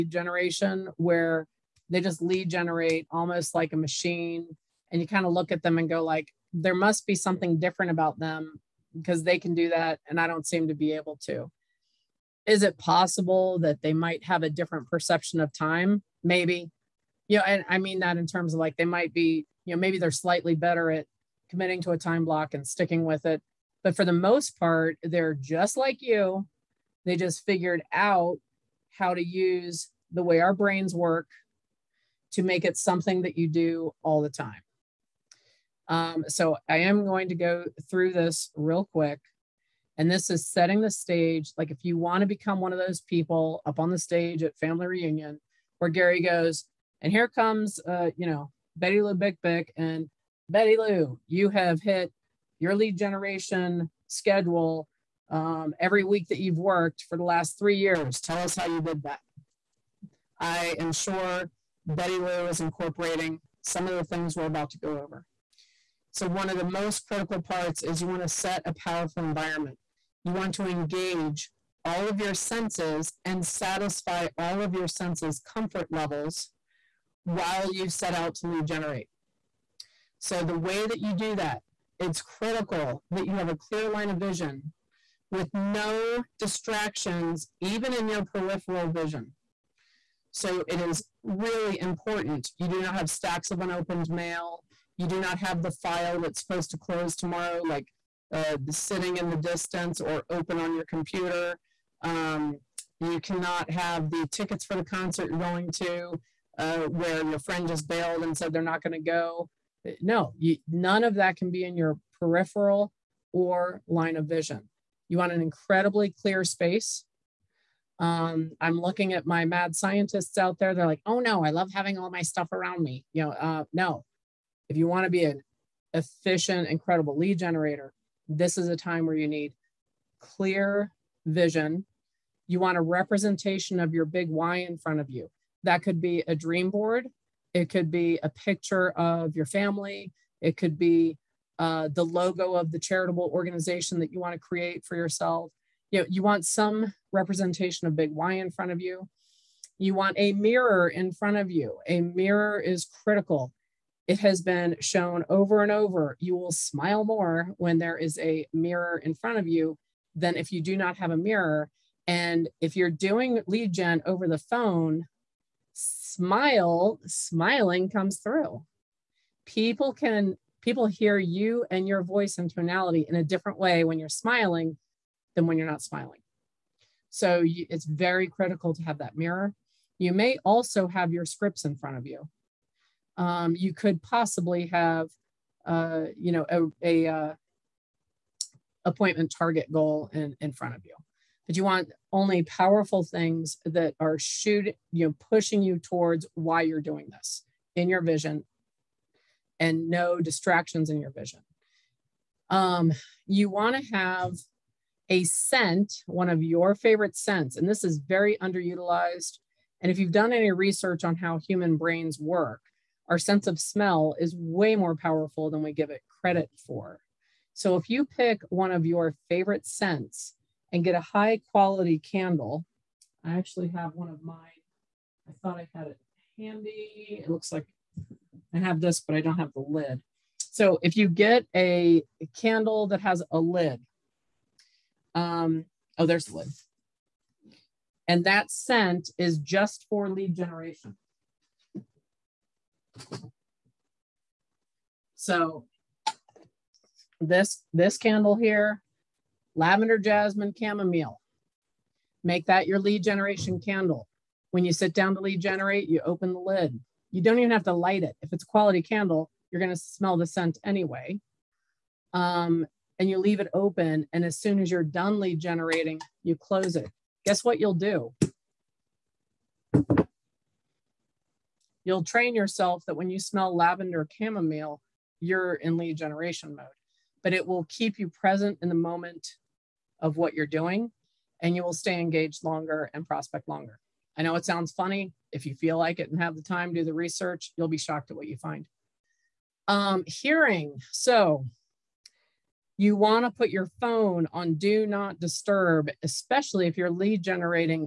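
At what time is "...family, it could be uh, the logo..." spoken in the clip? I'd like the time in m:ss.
2:19.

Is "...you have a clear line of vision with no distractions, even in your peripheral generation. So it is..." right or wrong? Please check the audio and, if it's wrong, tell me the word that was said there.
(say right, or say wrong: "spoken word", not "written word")
wrong: "vision", not "generation".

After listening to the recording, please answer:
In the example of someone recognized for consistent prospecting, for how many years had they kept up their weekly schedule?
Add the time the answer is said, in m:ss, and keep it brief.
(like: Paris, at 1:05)
3, at 0:57.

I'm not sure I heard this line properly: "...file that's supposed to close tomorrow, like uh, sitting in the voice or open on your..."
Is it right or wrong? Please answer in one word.
wrong.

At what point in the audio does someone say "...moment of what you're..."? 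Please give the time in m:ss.
4:38.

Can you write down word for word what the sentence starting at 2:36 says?
You will smile more when there is a mirror in front of you than if you do not have a mirror.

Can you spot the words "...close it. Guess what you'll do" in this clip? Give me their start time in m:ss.
4:26.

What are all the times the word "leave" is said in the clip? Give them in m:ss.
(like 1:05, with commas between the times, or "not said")
4:23.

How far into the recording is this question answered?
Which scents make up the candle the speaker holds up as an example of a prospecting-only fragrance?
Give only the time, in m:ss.
4:09.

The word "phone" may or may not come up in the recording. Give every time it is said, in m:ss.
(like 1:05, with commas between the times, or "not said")
2:44, 4:53.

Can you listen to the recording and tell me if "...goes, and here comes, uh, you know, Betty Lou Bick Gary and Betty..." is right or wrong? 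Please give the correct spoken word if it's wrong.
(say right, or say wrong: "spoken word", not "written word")
wrong: "Bick", not "Gary".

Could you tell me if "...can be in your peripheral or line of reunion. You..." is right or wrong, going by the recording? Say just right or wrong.
wrong.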